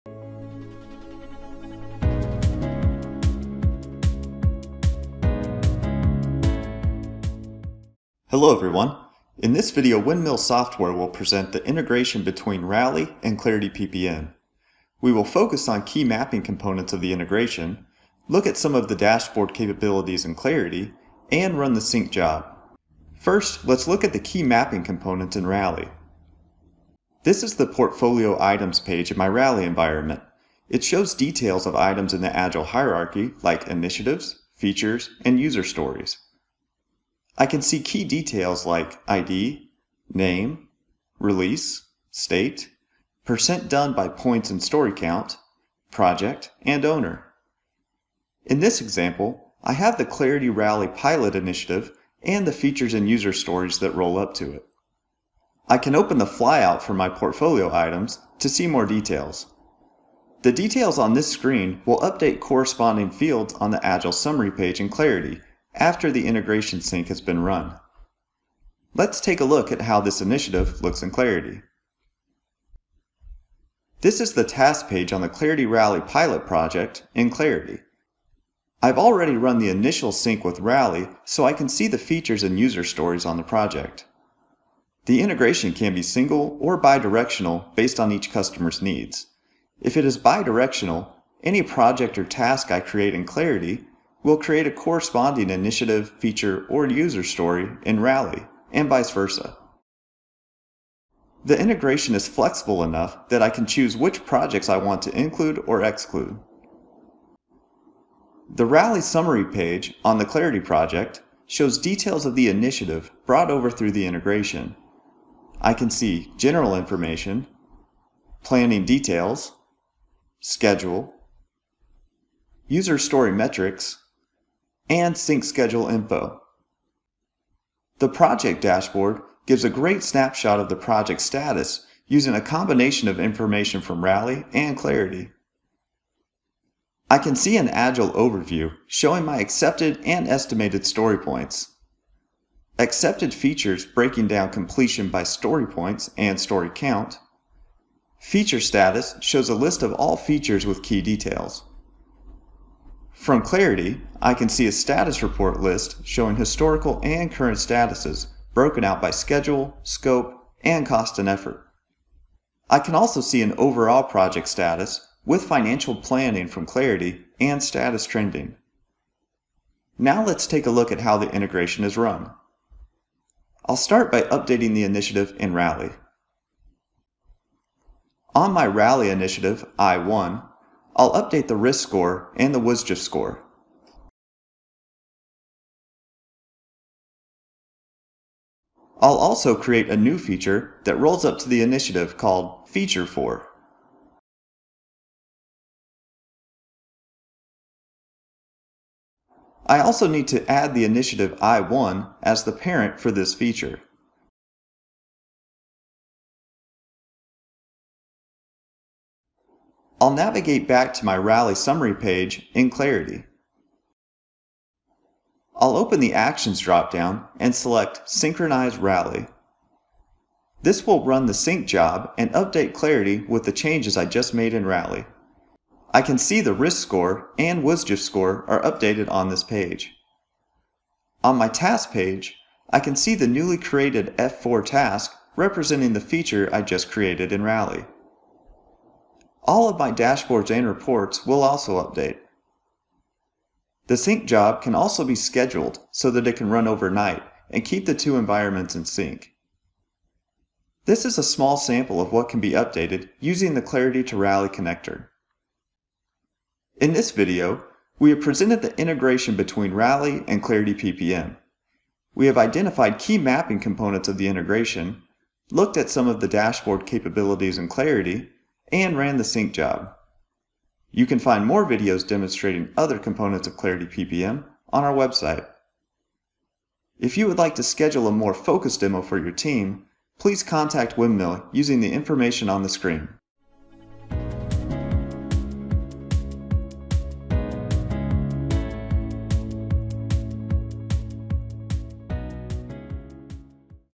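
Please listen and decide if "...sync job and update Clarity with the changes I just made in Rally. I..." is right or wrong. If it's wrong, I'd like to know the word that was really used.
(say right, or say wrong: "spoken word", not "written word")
right.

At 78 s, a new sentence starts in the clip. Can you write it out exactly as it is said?
I've already run the initial sync with Rally so I can see the features and user stories on the project.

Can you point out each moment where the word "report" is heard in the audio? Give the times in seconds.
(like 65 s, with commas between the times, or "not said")
155 s, 240 s.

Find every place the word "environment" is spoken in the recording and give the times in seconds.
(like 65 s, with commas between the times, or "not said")
29 s, 248 s.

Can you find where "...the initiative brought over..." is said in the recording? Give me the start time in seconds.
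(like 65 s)
112 s.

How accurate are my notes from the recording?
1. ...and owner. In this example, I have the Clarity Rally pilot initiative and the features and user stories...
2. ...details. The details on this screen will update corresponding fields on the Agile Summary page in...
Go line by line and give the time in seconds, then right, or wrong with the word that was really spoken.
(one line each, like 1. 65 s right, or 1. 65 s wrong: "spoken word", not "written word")
1. 46 s right
2. 58 s right.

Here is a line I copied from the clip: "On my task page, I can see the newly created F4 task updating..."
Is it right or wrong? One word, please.
wrong.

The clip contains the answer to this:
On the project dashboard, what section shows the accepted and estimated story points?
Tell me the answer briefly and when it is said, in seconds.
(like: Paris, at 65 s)
Agile overview, at 137 s.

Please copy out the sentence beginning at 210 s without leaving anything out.
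I'll navigate back to my Rally Summary page in Clarity.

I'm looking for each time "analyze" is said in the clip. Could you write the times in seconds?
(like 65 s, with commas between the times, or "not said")
not said.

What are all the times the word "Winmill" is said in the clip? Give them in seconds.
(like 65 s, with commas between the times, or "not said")
10 s, 280 s.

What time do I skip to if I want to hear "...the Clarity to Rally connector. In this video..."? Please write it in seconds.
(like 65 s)
253 s.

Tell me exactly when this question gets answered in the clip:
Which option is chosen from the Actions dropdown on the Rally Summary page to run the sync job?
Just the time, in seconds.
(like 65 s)
218 s.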